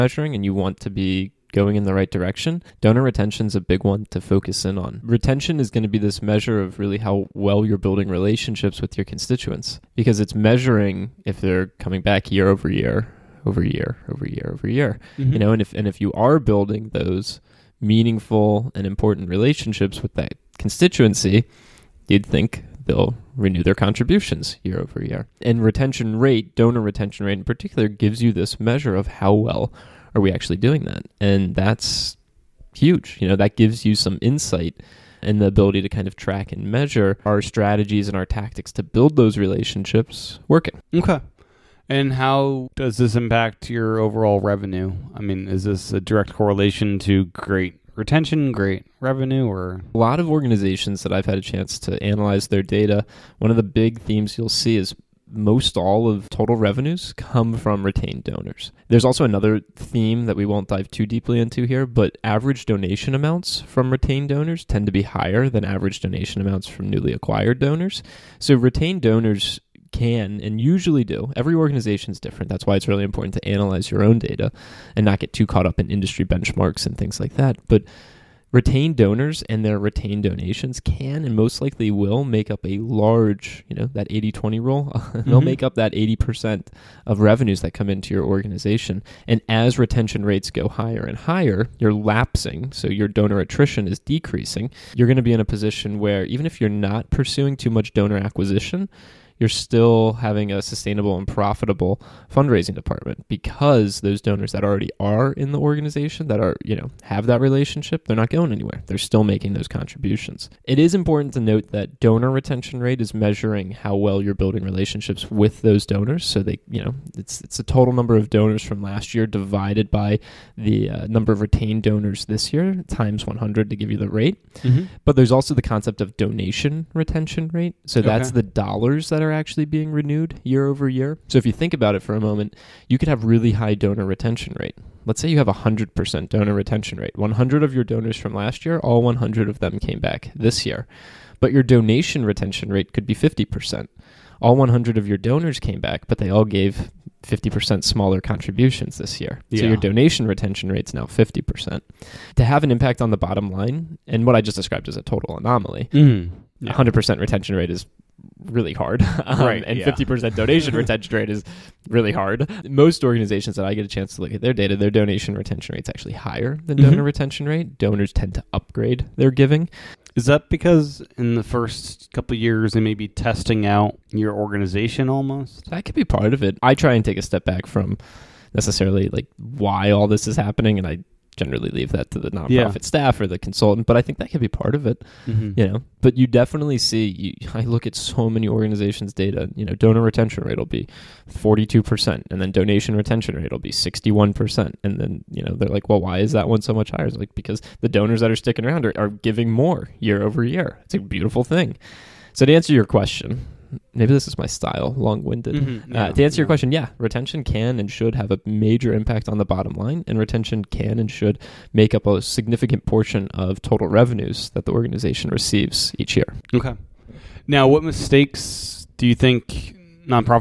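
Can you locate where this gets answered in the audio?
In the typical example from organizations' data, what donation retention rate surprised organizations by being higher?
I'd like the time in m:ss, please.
3:13.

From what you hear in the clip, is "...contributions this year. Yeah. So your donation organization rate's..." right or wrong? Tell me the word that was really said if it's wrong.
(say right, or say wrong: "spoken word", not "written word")
wrong: "retention", not "organization".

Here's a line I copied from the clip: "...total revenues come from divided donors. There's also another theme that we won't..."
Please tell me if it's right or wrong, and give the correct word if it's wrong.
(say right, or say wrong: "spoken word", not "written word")
wrong: "retained", not "divided".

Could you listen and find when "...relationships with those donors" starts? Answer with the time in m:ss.
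1:54.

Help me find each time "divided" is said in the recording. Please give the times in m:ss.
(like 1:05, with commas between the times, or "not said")
1:59.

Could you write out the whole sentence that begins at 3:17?
It's like because the donors that are sticking around are, are giving more year over year.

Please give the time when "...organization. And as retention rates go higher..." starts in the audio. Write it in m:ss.
1:28.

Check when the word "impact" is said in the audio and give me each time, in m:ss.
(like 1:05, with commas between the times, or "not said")
0:43, 2:32, 3:28.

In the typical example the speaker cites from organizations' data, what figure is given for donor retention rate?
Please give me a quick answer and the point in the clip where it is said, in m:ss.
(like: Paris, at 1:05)
42%, at 3:11.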